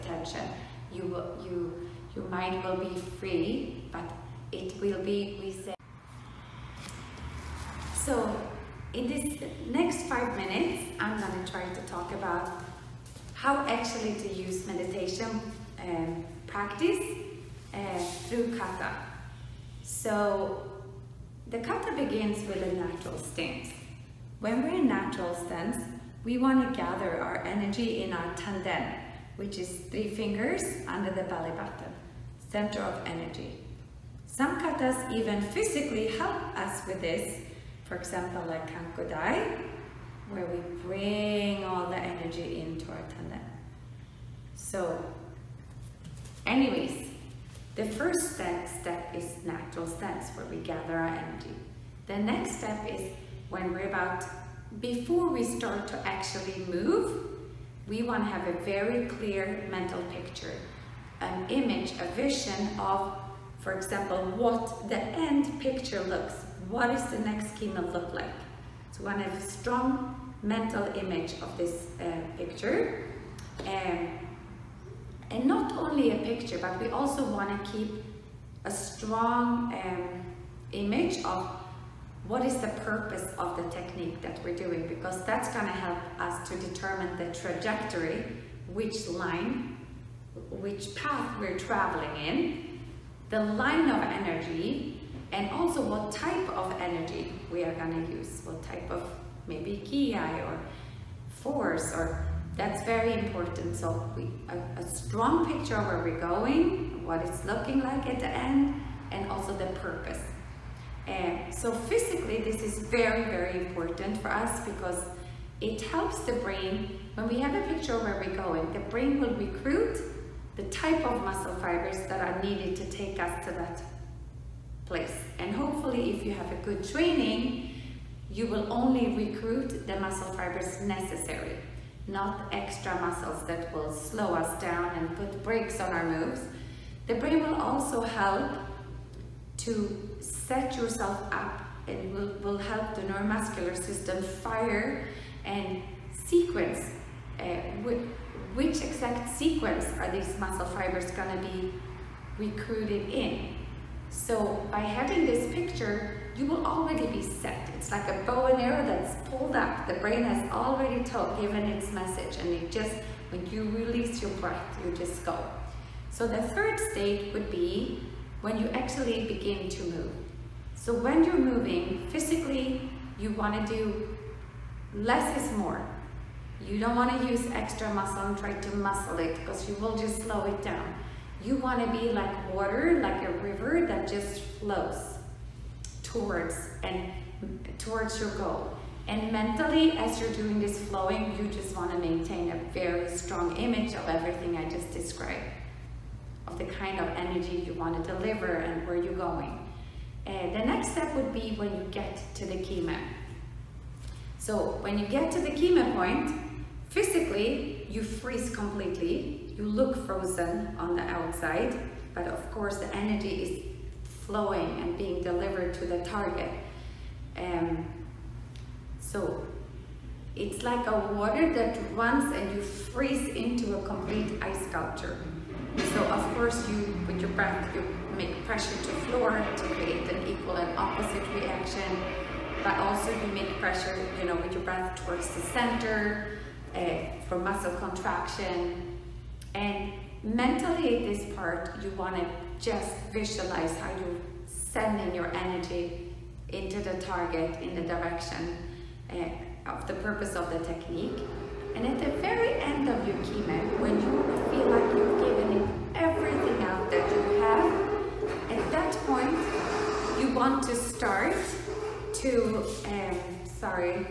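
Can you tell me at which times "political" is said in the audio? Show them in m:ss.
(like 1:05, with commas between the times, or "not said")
not said.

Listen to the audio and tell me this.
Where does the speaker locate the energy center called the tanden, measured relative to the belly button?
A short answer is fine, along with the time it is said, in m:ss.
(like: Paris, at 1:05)
3 fingers under the belly button, at 0:29.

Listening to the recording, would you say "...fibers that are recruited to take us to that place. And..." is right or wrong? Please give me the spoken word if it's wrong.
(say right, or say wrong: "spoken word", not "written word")
wrong: "needed", not "recruited".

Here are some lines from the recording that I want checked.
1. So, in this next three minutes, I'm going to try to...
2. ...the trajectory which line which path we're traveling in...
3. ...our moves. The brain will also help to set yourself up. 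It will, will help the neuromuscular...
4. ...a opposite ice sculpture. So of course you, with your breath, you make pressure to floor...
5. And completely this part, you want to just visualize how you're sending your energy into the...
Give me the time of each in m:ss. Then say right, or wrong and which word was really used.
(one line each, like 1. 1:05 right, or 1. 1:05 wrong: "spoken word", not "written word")
1. 0:07 wrong: "five", not "three"
2. 1:27 right
3. 2:15 right
4. 3:43 wrong: "complete", not "opposite"
5. 3:59 wrong: "mentally", not "completely".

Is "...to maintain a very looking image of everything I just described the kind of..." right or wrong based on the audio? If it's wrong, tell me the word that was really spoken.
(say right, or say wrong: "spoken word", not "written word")
wrong: "strong", not "looking".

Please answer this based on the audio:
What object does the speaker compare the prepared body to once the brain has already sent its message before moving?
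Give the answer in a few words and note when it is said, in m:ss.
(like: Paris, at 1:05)
A bow and arrow, at 2:38.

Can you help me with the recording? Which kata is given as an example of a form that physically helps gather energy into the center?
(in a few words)
Kanku Dai.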